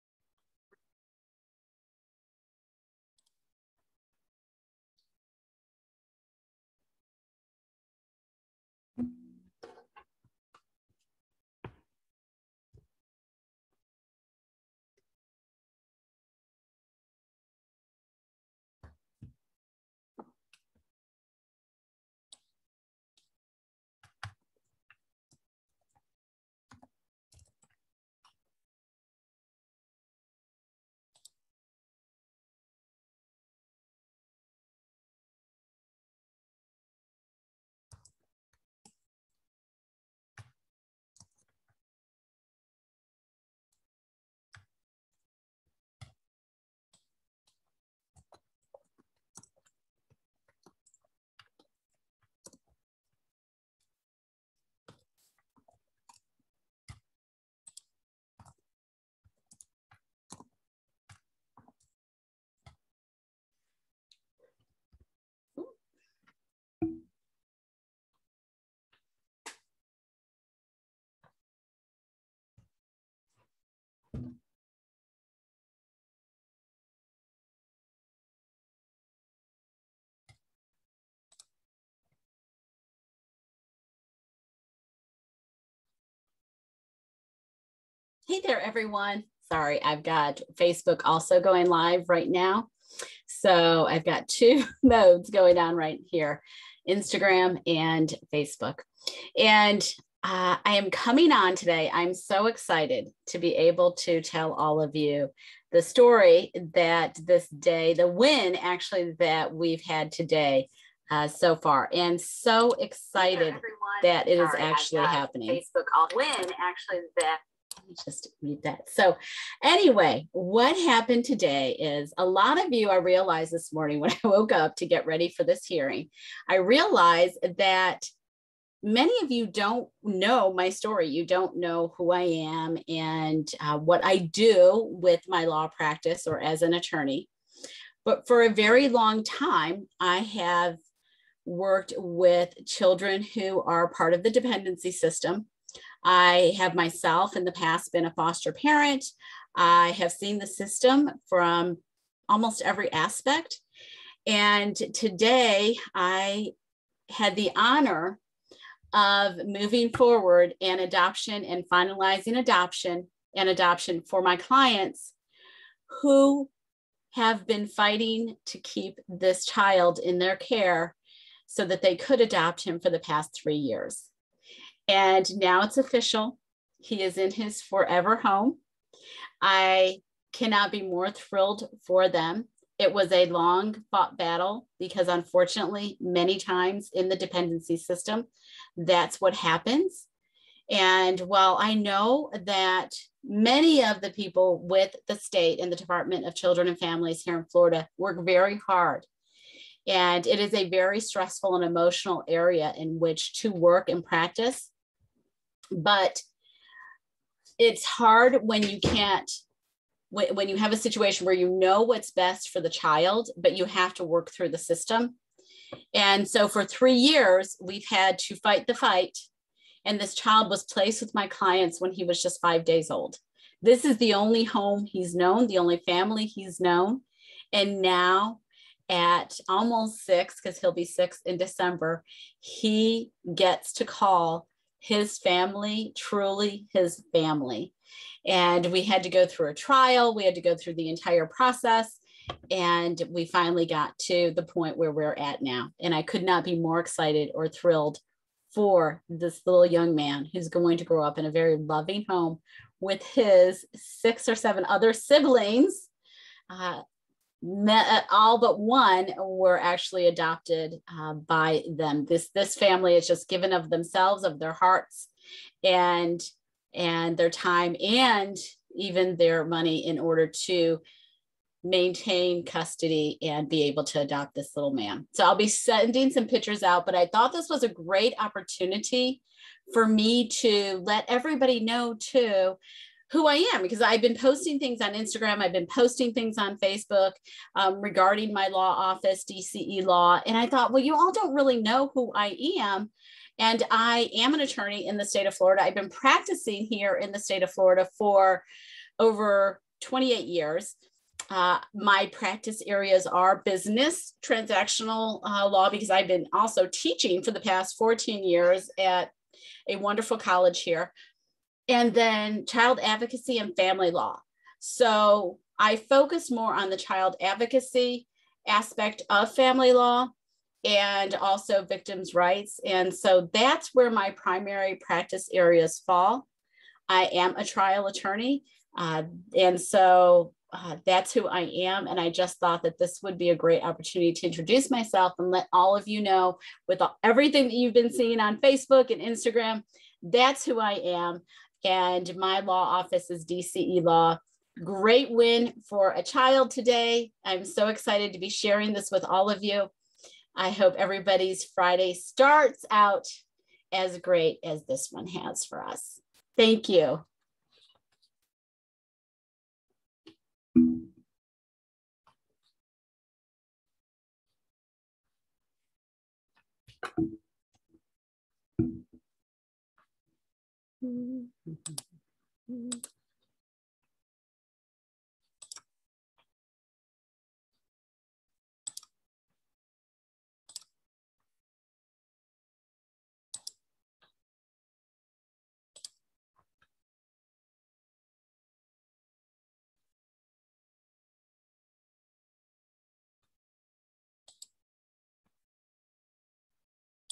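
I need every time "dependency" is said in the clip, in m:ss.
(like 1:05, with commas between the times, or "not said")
2:24, 3:07.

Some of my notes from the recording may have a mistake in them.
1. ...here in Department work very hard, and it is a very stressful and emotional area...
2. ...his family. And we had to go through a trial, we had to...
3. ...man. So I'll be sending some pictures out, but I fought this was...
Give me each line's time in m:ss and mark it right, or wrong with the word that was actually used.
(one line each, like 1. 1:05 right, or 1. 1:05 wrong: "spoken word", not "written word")
1. 3:17 wrong: "Florida", not "Department"
2. 3:56 right
3. 4:34 wrong: "thought", not "fought".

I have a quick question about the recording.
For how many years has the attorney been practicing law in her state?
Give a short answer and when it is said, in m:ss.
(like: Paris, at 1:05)
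over 28, at 4:58.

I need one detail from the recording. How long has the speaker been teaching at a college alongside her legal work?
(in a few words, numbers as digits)
14 years.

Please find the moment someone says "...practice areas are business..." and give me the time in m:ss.
5:02.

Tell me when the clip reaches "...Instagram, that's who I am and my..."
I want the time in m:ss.
5:39.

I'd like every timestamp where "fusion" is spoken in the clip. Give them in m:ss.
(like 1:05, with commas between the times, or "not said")
not said.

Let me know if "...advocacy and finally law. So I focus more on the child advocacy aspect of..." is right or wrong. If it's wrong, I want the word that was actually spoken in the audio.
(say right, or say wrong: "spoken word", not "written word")
wrong: "family", not "finally".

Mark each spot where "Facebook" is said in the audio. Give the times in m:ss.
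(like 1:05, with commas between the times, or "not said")
1:30, 1:38, 1:55, 4:46, 5:38.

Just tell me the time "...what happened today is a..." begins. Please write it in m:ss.
2:00.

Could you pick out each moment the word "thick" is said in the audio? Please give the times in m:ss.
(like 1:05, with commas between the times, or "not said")
not said.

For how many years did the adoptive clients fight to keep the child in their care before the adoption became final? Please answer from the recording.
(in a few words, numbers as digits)
3.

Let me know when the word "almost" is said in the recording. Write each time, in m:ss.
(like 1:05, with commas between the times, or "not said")
2:32, 3:49.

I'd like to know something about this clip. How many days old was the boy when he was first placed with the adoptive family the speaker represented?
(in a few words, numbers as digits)
5.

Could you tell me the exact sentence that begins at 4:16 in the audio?
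Uh, uh, all but one were actually adopted uh, by them.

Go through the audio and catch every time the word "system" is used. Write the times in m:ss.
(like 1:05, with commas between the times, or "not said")
2:24, 2:30, 3:07, 3:34.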